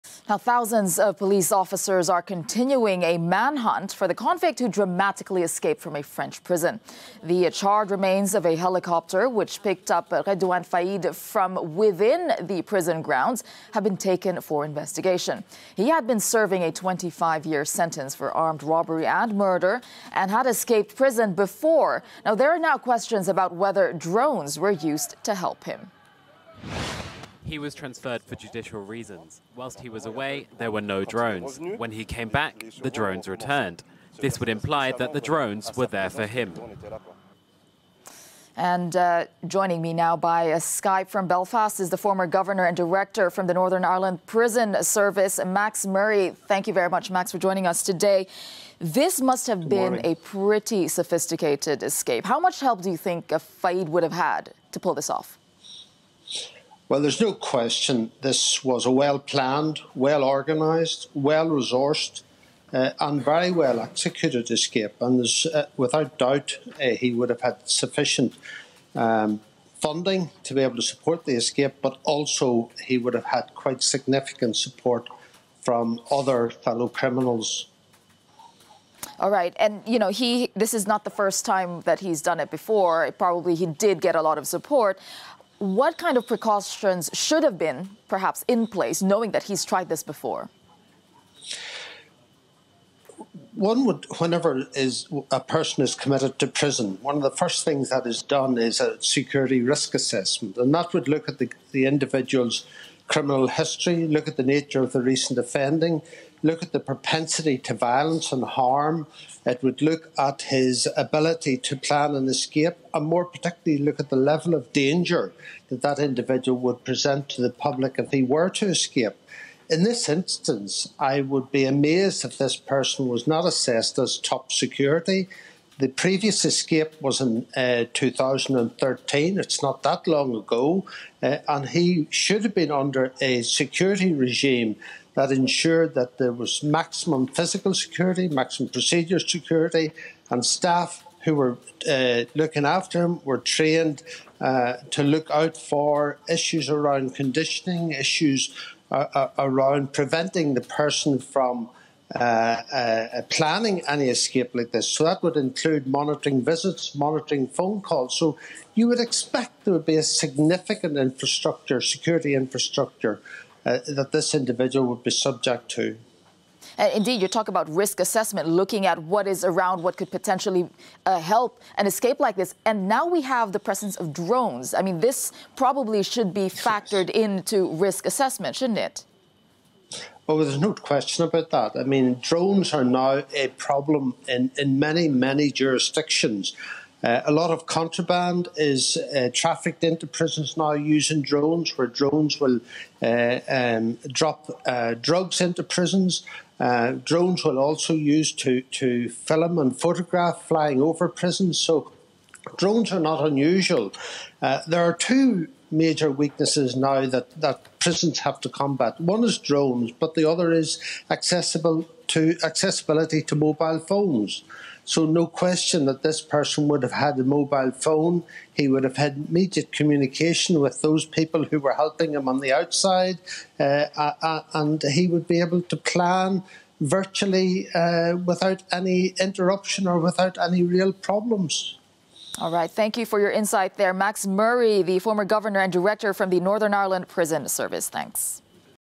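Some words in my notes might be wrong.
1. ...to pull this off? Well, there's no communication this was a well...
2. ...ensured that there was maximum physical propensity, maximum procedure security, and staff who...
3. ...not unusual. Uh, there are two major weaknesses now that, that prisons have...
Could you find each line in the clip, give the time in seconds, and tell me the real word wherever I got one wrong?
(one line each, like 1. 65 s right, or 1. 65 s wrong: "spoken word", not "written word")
1. 54 s wrong: "question", not "communication"
2. 135 s wrong: "security", not "propensity"
3. 203 s right.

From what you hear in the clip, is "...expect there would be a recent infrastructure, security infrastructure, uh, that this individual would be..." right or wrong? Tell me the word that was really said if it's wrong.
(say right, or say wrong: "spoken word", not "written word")
wrong: "significant", not "recent".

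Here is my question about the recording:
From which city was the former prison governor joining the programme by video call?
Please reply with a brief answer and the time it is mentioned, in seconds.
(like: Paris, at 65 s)
Belfast, at 41 s.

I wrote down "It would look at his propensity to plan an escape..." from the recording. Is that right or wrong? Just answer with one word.
wrong.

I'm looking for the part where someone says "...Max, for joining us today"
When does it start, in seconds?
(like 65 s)
47 s.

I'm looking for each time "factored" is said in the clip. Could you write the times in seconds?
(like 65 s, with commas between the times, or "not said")
176 s.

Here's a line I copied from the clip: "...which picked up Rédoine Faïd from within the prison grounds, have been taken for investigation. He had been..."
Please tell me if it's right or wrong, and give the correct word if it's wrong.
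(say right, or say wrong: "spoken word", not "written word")
right.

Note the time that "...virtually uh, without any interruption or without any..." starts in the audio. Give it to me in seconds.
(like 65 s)
226 s.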